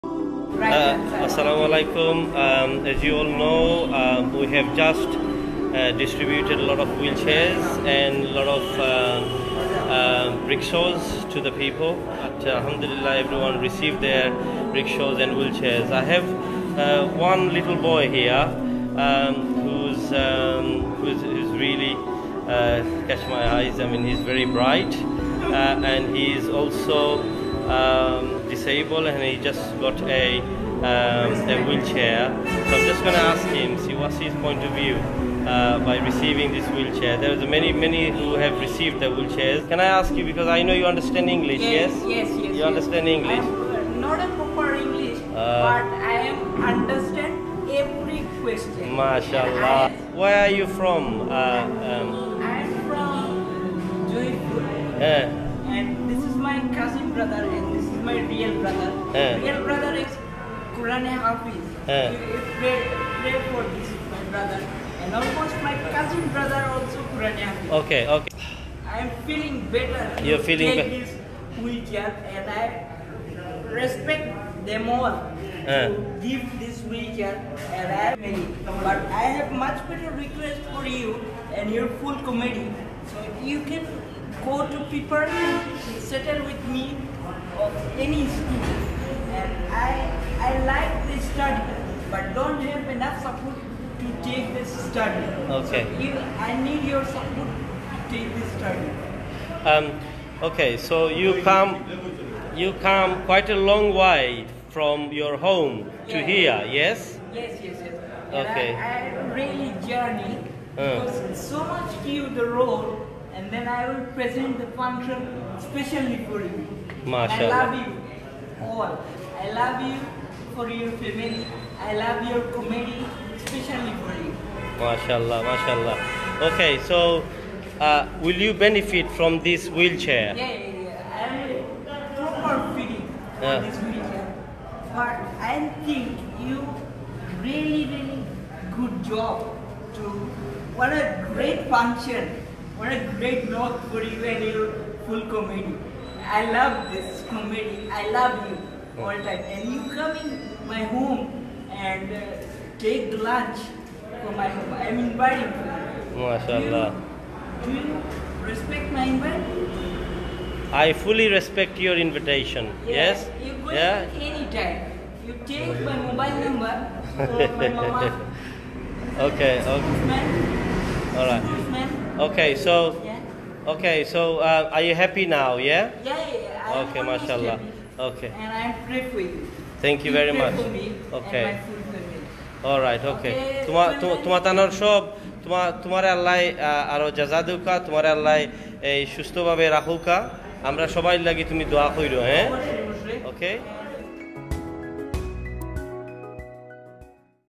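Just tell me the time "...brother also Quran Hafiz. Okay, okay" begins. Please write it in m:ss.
1:06.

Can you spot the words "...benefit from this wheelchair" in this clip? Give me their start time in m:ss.
2:08.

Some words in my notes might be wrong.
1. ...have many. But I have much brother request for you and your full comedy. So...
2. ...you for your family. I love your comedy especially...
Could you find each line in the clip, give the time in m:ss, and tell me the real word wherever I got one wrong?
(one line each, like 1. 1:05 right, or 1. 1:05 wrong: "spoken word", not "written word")
1. 1:18 wrong: "better", not "brother"
2. 1:59 right.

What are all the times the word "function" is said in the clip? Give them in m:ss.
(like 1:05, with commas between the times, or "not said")
1:54, 2:21.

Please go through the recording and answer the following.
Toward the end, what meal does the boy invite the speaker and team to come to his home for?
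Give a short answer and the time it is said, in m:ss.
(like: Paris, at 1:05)
Lunch, at 2:33.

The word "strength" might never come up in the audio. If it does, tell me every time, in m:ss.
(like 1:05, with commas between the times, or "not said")
not said.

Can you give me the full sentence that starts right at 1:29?
And I, I like this study, but don't have enough support to take this study.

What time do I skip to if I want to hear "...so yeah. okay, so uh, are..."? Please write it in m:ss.
2:52.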